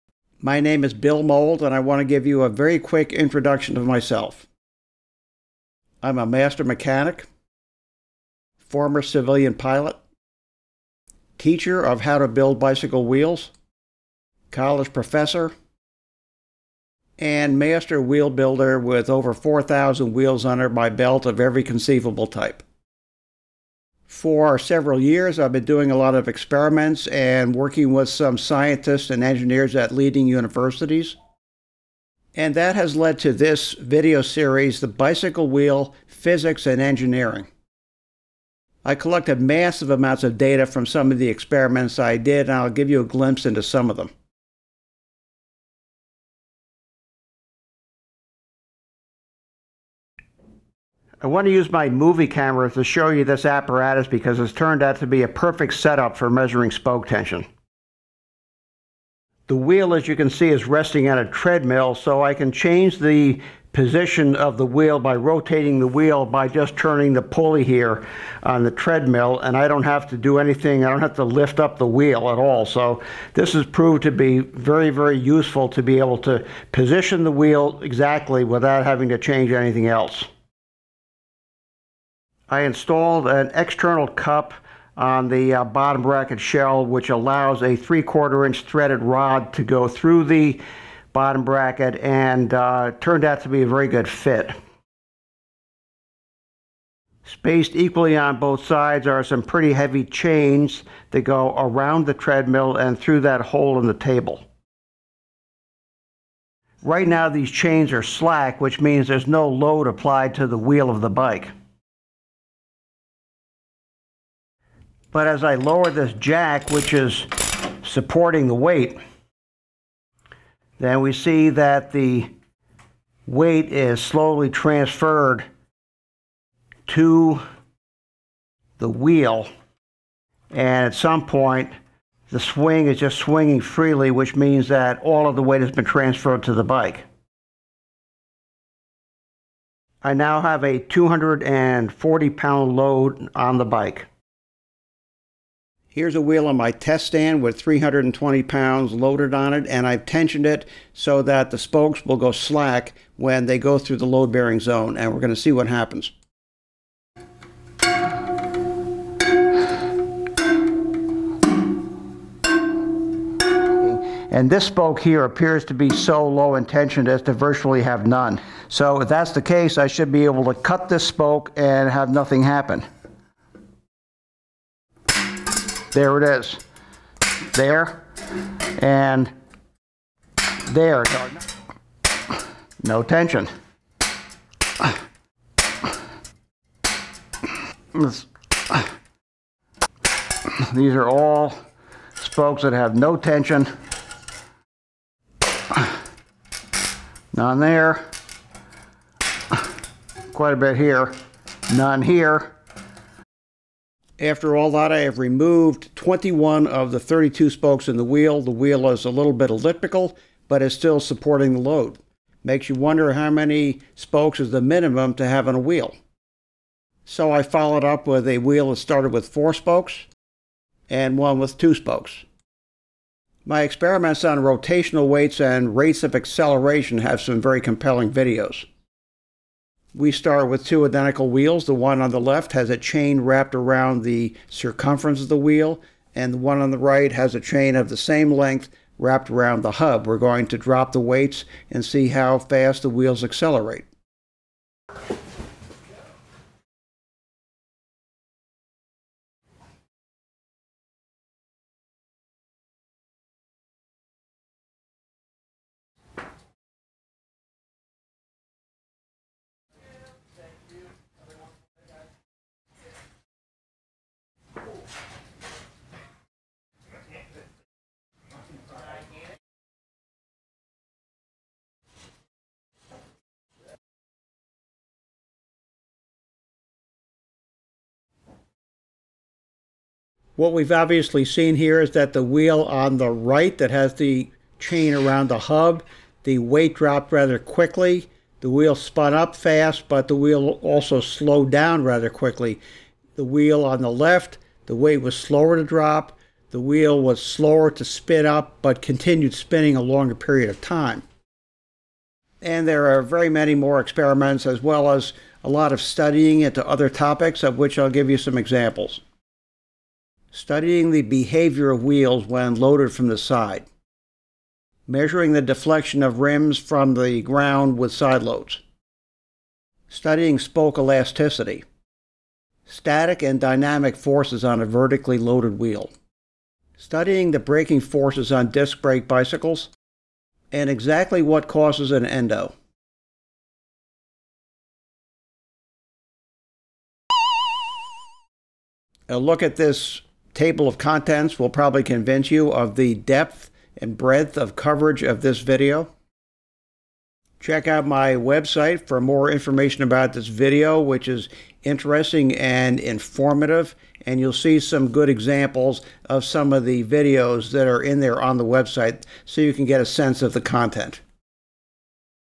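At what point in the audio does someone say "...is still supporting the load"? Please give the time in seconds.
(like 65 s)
210 s.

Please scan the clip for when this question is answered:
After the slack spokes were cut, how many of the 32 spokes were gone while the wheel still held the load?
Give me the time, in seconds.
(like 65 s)
205 s.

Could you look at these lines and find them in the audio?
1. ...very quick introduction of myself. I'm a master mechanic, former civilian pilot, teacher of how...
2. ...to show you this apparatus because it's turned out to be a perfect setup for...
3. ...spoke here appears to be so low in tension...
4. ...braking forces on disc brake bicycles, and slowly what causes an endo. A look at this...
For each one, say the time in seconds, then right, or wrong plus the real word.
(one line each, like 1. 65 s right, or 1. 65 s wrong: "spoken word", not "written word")
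1. 2 s right
2. 52 s right
3. 164 s right
4. 327 s wrong: "exactly", not "slowly".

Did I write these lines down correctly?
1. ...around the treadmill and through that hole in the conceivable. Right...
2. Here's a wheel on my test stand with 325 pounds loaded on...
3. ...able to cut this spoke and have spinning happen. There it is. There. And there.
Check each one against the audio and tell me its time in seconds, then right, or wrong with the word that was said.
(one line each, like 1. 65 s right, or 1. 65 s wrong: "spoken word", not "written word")
1. 101 s wrong: "table", not "conceivable"
2. 145 s wrong: "320", not "325"
3. 170 s wrong: "nothing", not "spinning".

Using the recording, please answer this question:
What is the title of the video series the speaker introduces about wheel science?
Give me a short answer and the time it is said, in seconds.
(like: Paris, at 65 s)
The Bicycle Wheel Physics and Engineering, at 34 s.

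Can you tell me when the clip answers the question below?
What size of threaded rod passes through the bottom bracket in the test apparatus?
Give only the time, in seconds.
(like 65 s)
87 s.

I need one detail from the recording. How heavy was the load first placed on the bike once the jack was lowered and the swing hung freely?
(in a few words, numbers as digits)
240 pounds.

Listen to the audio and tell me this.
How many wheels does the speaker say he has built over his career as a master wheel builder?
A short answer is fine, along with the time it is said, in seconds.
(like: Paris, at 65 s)
over 4,000, at 19 s.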